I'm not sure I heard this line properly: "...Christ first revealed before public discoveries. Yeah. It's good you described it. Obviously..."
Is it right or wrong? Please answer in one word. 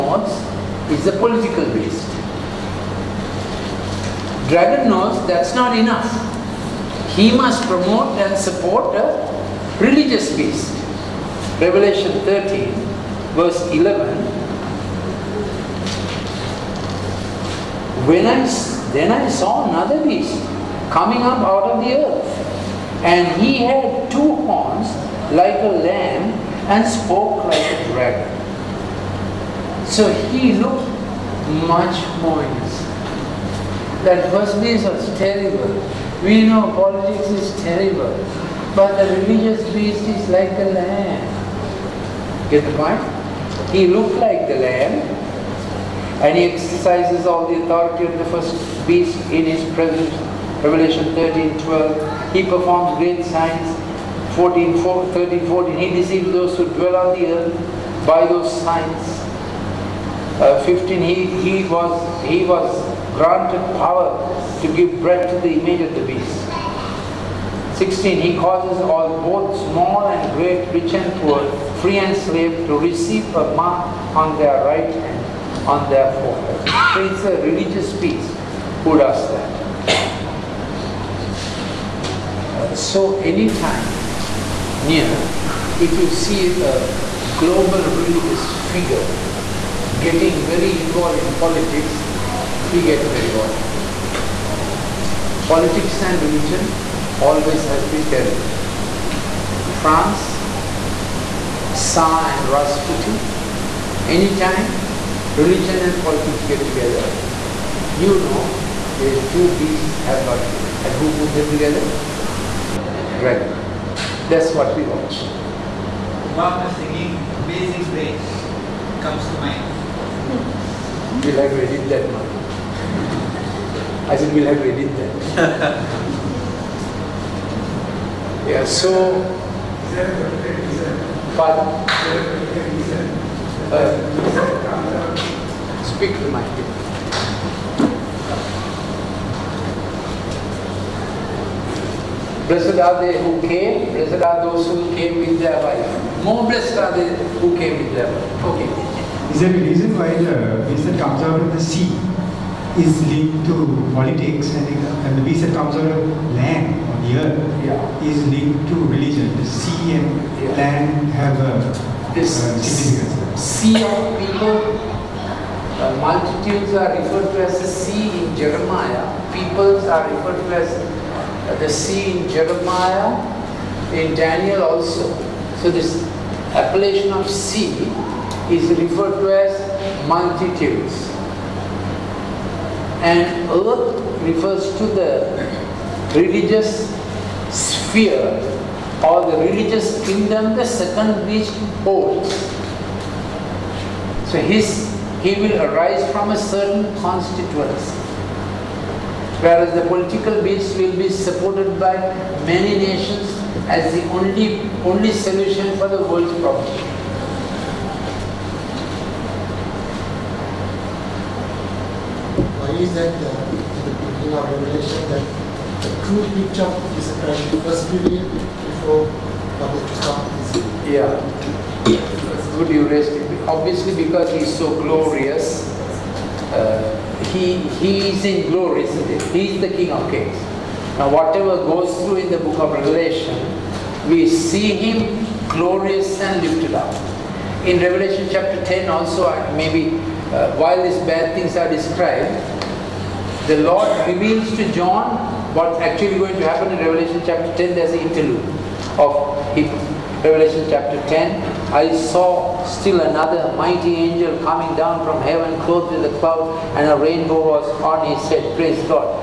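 wrong.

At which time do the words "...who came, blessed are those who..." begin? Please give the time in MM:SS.
02:23.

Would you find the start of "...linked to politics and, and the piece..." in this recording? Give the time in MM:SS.
02:33.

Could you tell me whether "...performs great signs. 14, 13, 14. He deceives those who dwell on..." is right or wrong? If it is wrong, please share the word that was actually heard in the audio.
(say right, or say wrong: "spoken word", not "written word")
right.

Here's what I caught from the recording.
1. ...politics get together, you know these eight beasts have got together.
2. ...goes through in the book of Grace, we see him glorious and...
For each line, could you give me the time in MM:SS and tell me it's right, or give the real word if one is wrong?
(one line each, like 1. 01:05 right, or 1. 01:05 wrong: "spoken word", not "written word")
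1. 01:46 wrong: "two", not "eight"
2. 03:51 wrong: "Revelation", not "Grace".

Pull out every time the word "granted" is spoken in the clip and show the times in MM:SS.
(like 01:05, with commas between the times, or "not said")
01:03.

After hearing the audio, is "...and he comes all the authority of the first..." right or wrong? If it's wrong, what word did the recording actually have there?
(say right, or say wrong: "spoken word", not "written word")
wrong: "exercises", not "comes".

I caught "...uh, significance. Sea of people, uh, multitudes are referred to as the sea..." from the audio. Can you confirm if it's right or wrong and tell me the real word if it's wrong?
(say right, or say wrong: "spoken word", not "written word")
right.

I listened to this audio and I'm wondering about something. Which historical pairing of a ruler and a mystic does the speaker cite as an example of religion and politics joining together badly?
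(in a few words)
Tsar and Rasputin.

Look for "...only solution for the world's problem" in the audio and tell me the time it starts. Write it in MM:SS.
03:24.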